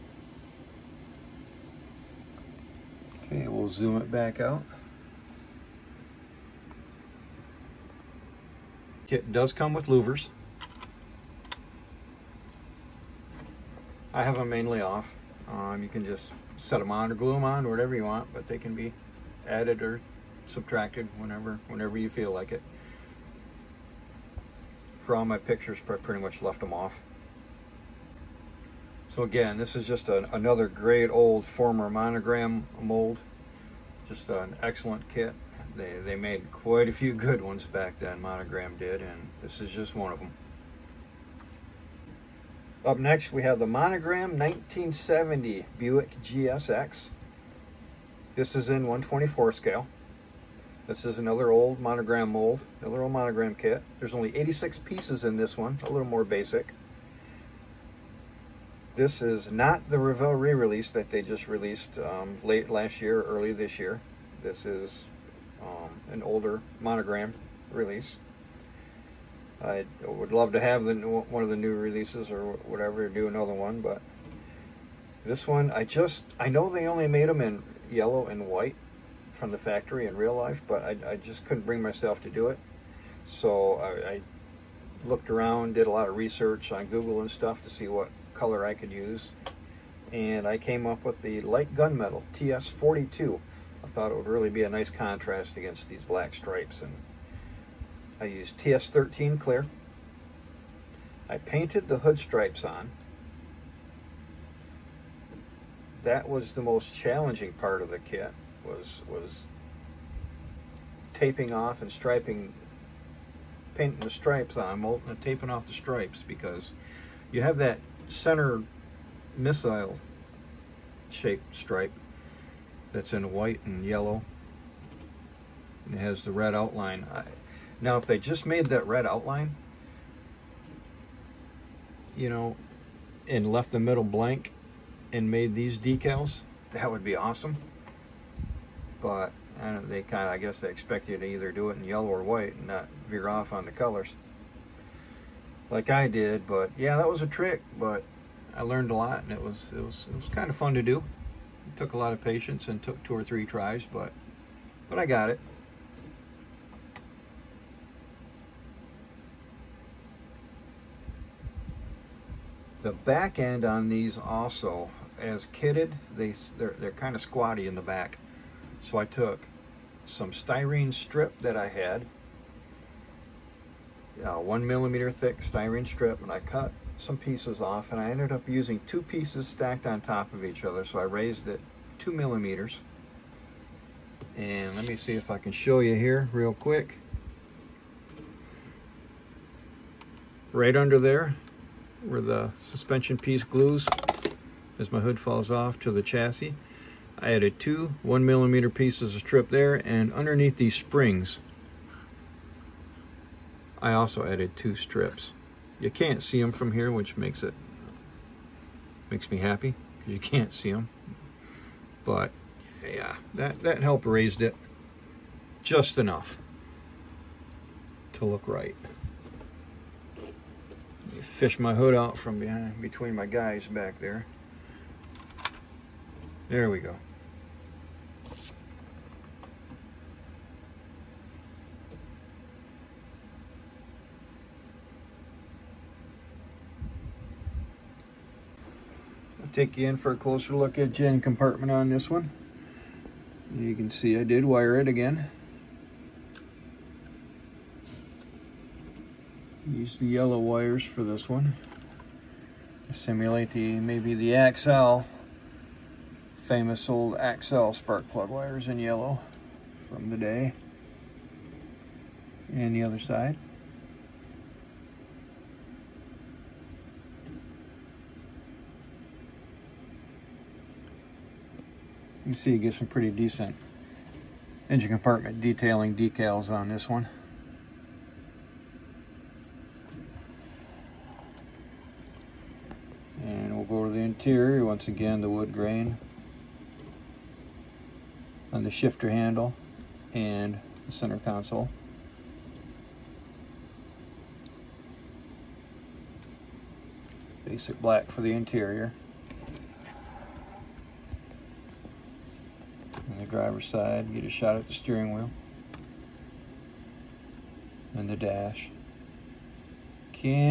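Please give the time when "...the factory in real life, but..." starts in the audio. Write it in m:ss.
1:19.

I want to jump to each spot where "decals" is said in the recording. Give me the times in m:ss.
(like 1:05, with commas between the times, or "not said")
2:15, 4:35.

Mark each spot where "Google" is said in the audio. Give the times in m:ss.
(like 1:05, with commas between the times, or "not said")
1:26.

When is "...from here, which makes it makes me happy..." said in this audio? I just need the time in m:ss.
3:26.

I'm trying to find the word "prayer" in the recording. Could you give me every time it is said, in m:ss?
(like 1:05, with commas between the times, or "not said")
not said.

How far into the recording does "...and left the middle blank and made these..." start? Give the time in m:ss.
2:13.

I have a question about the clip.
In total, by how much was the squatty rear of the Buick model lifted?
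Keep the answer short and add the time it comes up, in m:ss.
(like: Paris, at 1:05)
2 millimeters, at 3:01.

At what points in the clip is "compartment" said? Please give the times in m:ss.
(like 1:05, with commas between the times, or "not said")
4:01, 4:34.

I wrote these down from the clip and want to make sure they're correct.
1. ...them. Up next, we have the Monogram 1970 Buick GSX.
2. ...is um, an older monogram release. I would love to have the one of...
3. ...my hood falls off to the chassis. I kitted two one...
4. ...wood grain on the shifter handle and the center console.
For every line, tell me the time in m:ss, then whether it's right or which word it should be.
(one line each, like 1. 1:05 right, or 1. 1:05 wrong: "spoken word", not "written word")
1. 0:40 right
2. 1:04 right
3. 3:14 wrong: "added", not "kitted"
4. 4:45 right.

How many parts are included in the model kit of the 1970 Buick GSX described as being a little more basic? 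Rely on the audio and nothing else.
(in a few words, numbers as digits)
86.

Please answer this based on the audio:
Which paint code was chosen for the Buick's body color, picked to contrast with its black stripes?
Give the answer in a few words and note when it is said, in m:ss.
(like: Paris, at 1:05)
TS42, at 1:32.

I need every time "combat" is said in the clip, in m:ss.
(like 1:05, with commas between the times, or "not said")
not said.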